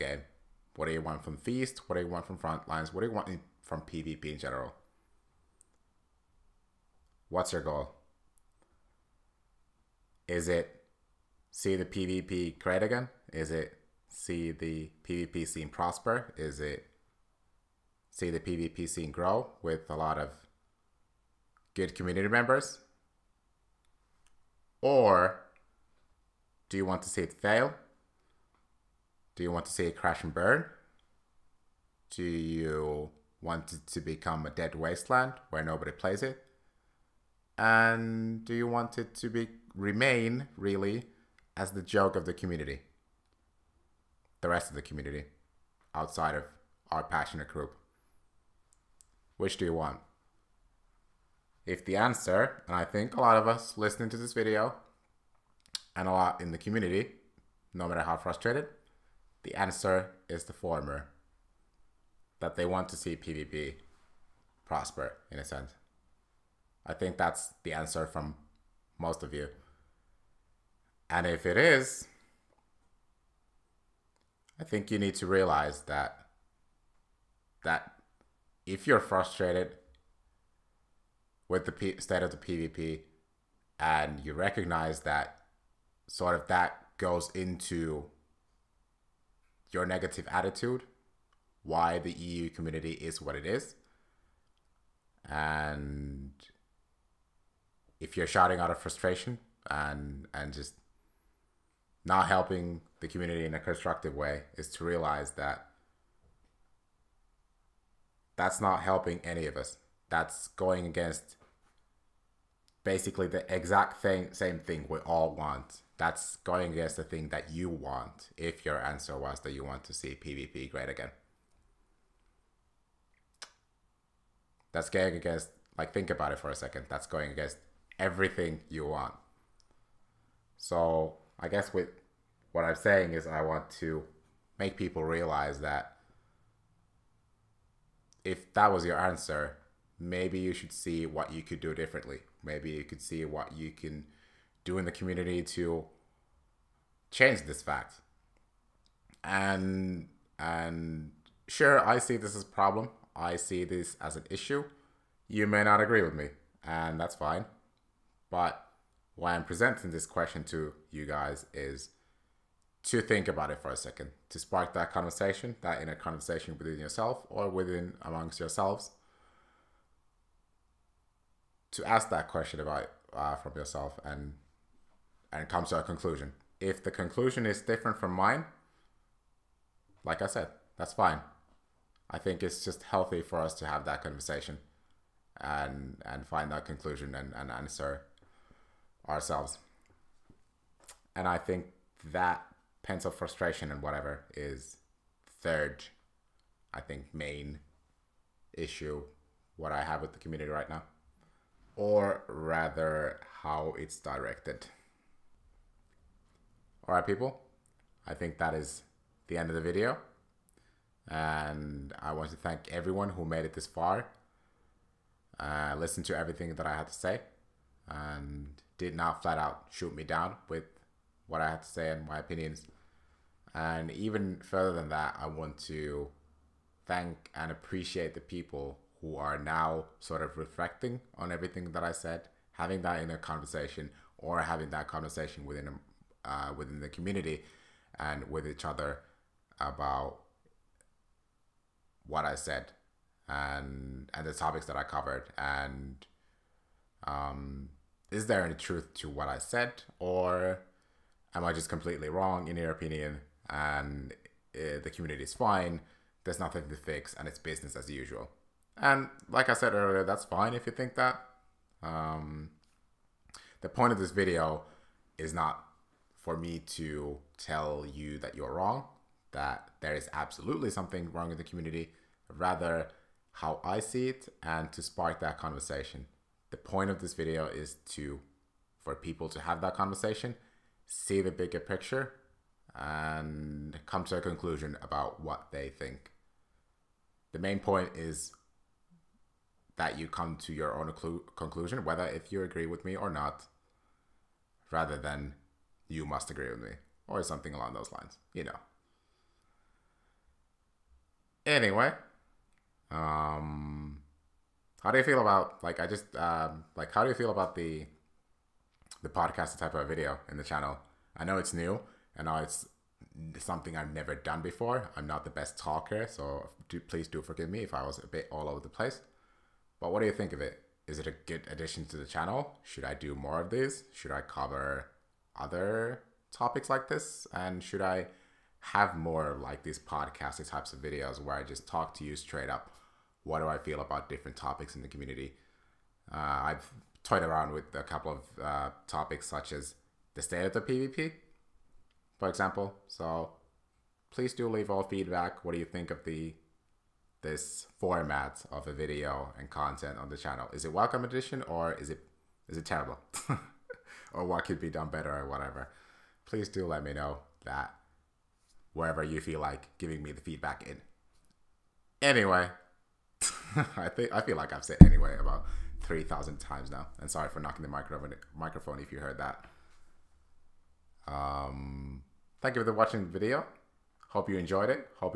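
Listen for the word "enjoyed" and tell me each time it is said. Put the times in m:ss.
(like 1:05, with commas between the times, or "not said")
6:14.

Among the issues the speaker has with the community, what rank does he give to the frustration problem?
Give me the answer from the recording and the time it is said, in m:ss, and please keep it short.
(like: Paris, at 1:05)
third, at 3:15.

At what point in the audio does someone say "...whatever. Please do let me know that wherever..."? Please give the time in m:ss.
5:55.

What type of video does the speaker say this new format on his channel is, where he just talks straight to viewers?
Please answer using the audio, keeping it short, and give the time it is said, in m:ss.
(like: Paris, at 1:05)
podcast, at 5:09.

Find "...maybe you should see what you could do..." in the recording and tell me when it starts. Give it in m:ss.
2:19.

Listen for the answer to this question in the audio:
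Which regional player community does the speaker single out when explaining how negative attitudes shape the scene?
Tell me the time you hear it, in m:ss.
1:32.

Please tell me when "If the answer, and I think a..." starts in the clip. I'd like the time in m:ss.
0:51.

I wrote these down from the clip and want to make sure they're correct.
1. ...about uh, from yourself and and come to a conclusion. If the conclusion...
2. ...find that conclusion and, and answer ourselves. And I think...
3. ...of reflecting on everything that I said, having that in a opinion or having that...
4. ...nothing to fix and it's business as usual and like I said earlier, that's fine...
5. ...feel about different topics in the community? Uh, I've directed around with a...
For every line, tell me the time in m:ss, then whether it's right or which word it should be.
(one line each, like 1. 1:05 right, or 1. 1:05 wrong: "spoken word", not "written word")
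1. 2:52 right
2. 3:06 right
3. 3:50 wrong: "conversation", not "opinion"
4. 4:16 right
5. 5:33 wrong: "toyed", not "directed".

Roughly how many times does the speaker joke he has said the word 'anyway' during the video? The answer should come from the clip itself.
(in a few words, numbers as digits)
3,000.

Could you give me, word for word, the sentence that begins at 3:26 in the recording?
All right, people, I think that is the end of the video.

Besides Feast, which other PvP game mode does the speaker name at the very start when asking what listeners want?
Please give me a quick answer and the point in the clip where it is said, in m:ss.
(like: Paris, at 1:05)
Frontlines, at 0:02.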